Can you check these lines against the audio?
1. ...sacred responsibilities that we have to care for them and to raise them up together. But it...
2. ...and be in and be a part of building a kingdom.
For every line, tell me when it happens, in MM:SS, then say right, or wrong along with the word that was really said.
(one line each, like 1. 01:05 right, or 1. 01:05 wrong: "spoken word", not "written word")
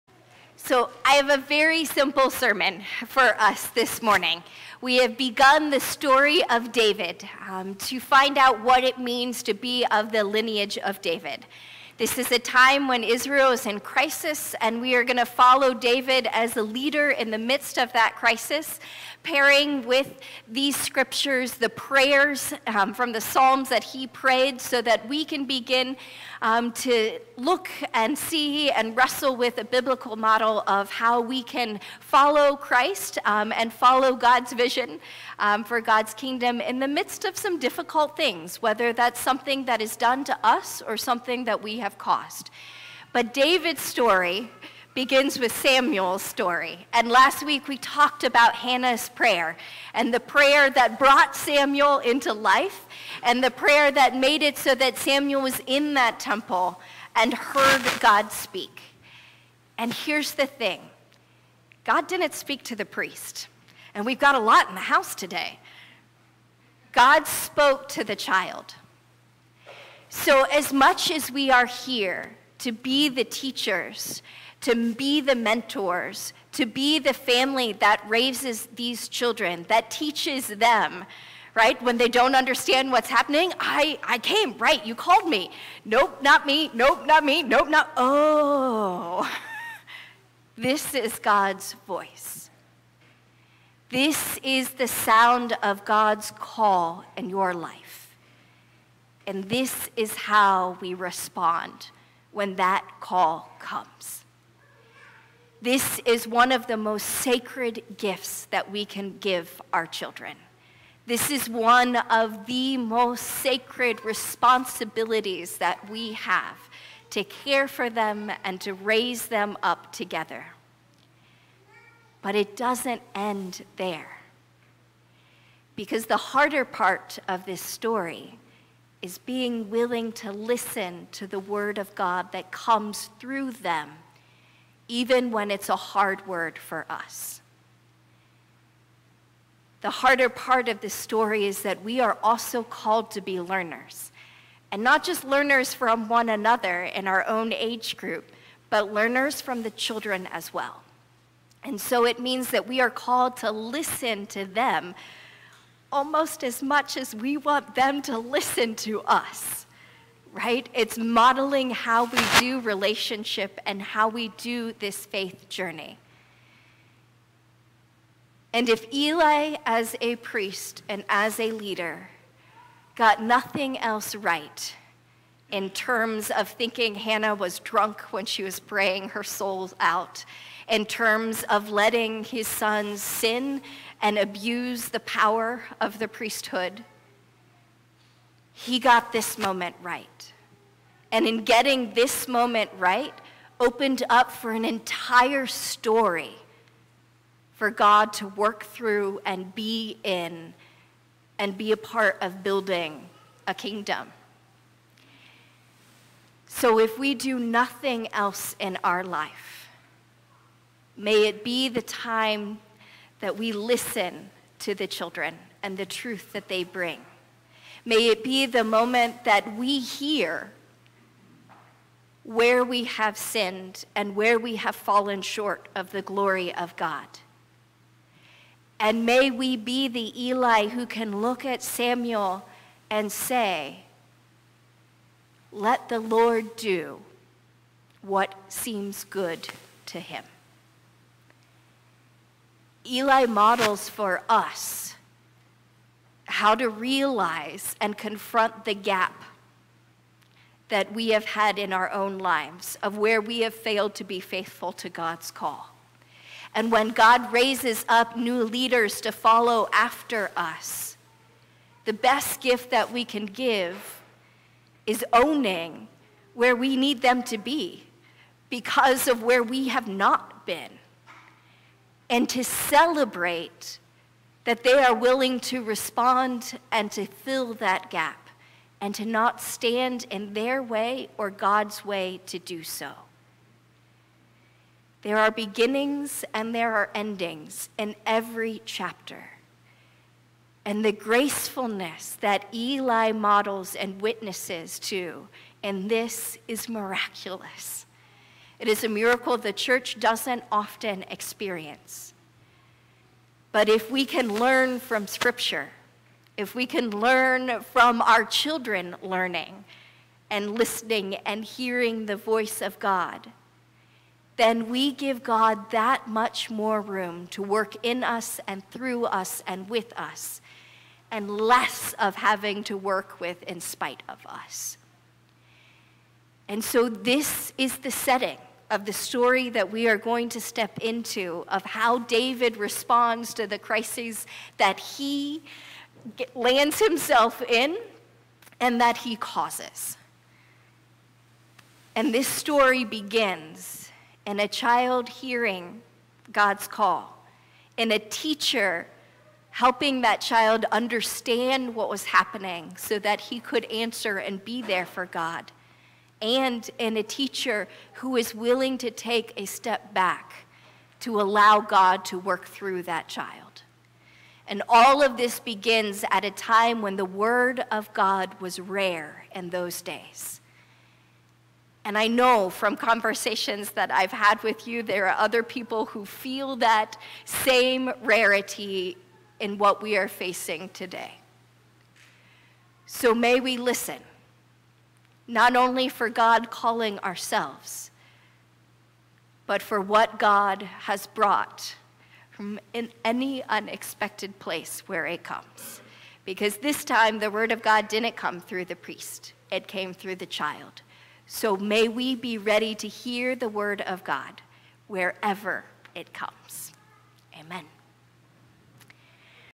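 1. 01:53 right
2. 03:19 right.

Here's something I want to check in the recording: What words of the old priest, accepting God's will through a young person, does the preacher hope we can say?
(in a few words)
Let the Lord do what seems good to him.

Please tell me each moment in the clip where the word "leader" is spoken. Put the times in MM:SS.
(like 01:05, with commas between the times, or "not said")
00:16, 02:51, 04:18.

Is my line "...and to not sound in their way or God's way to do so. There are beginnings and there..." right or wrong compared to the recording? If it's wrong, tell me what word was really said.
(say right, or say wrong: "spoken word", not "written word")
wrong: "stand", not "sound".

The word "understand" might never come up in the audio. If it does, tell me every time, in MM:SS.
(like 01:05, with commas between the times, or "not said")
01:22, 05:50.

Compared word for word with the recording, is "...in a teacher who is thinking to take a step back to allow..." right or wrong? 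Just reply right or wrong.
wrong.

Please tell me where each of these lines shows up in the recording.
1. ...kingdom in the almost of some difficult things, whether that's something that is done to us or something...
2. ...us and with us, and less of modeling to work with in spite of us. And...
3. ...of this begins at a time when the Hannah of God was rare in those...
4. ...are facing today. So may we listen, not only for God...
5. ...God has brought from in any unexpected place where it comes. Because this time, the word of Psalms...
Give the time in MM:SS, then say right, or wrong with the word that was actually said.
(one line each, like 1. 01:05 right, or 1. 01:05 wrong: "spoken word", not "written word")
1. 00:36 wrong: "midst", not "almost"
2. 05:19 wrong: "having", not "modeling"
3. 06:05 wrong: "Word", not "Hannah"
4. 06:19 right
5. 06:30 wrong: "God", not "Psalms".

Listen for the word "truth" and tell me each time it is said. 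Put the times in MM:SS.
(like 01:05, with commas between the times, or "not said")
03:35.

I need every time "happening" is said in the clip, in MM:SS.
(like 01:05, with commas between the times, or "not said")
01:23, 05:52.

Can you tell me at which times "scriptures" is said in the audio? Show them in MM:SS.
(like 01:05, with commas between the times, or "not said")
00:20, 05:05.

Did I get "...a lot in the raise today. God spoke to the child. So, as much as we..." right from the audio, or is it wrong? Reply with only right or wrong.
wrong.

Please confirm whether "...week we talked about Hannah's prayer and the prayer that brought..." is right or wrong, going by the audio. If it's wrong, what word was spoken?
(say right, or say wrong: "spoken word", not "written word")
right.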